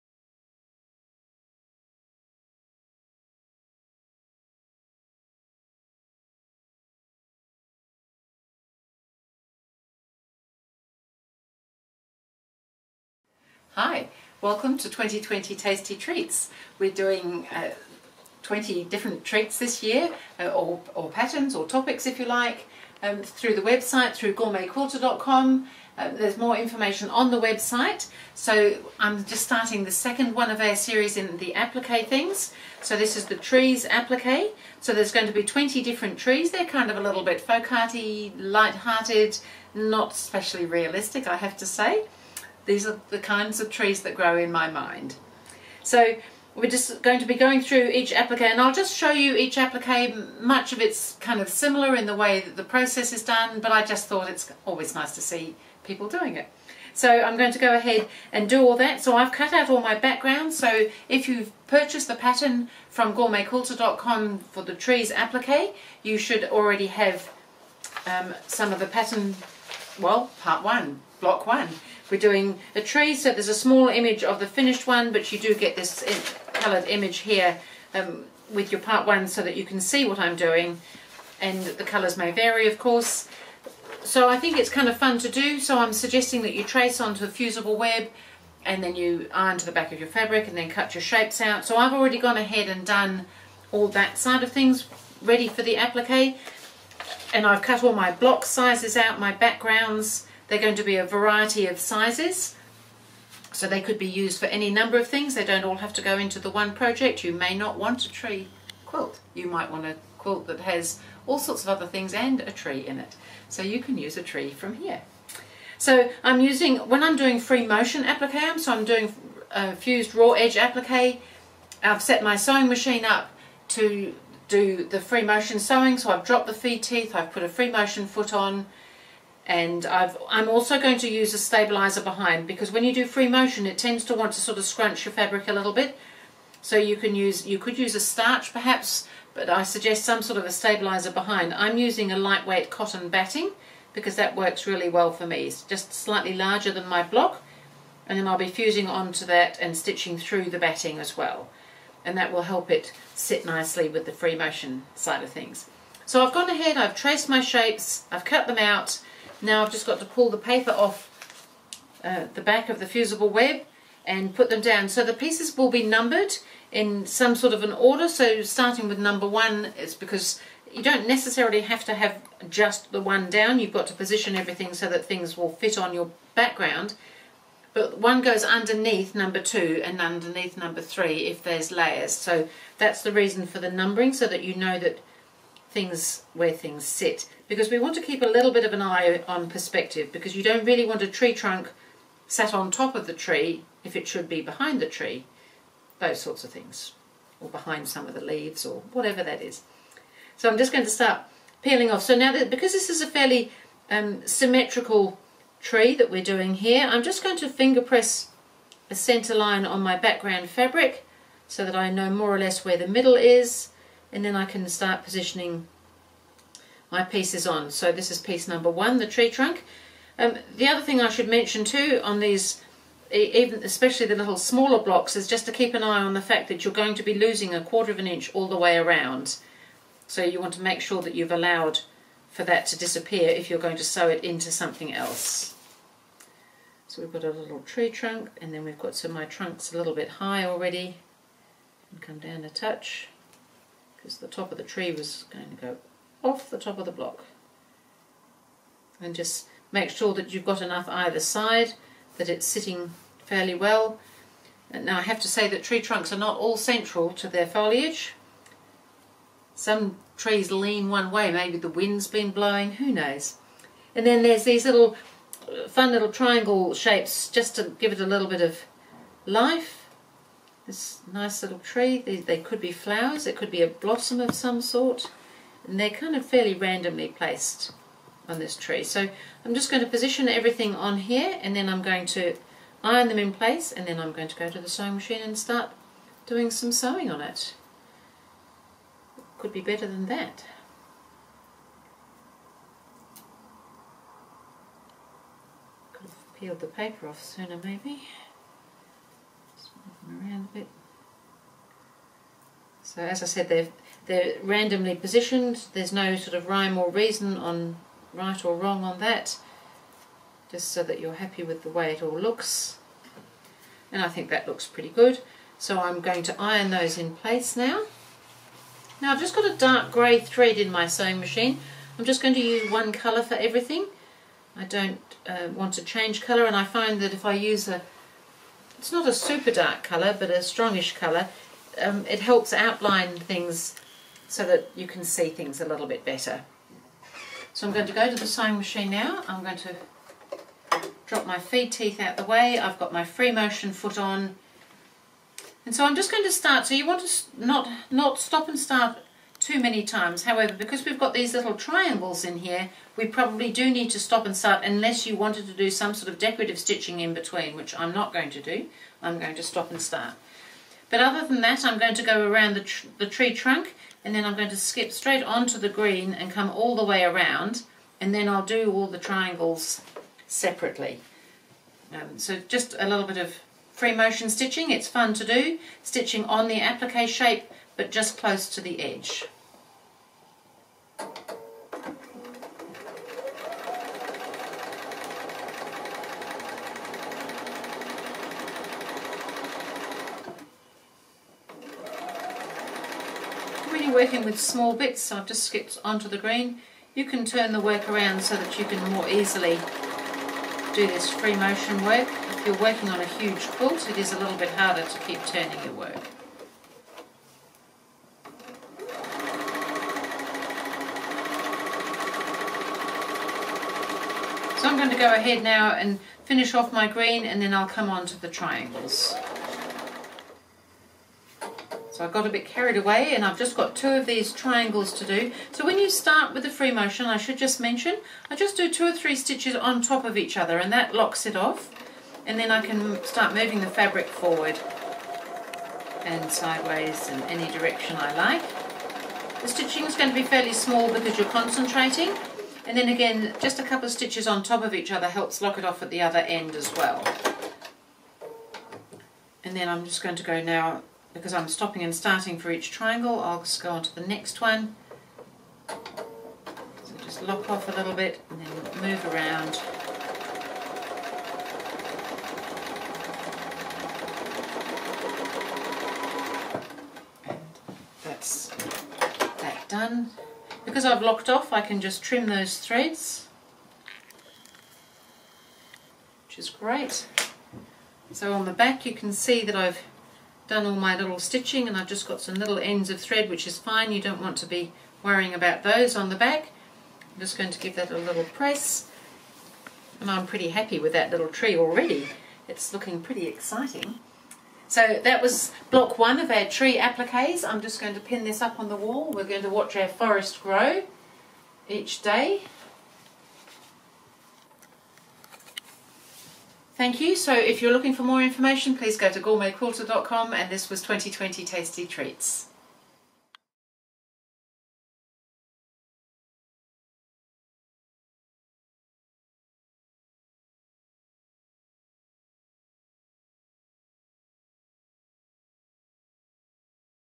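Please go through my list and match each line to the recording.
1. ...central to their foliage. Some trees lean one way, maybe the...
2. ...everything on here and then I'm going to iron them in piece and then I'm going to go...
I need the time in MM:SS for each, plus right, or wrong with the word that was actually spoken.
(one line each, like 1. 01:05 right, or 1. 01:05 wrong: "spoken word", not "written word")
1. 04:16 right
2. 04:40 wrong: "place", not "piece".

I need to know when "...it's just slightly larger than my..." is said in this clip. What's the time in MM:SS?
02:25.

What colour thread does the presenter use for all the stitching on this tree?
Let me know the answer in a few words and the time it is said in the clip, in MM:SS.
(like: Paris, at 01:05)
dark grey, at 05:19.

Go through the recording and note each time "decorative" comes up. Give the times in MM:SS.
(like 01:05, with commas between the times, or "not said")
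05:56.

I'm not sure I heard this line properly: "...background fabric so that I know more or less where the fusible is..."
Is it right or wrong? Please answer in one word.
wrong.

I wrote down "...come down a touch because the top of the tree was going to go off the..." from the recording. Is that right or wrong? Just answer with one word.
right.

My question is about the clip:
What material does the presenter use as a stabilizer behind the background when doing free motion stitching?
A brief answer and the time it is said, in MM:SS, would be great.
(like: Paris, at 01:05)
lightweight cotton batting, at 02:22.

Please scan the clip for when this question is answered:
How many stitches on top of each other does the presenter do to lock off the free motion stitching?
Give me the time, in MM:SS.
07:08.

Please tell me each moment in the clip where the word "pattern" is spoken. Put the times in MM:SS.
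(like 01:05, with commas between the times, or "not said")
00:21, 01:02, 01:08.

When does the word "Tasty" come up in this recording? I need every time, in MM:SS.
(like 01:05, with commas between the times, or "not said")
00:15, 08:31.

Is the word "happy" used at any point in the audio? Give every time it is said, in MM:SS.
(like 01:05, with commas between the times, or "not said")
05:11, 08:10.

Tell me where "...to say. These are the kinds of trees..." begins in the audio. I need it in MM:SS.
00:41.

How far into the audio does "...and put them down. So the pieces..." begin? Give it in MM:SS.
02:44.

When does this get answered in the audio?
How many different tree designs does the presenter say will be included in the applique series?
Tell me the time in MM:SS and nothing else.
00:35.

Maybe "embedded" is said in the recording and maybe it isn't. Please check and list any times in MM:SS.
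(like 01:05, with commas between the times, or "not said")
not said.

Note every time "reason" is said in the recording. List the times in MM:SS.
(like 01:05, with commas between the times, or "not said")
03:03, 05:06.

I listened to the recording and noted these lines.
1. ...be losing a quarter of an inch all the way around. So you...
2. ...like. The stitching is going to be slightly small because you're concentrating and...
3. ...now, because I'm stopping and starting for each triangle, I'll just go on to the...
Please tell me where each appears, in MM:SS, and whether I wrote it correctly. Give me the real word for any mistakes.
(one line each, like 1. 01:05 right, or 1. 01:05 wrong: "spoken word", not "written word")
1. 03:47 right
2. 07:18 wrong: "fairly", not "slightly"
3. 07:30 right.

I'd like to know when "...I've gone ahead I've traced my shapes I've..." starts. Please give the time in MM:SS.
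02:36.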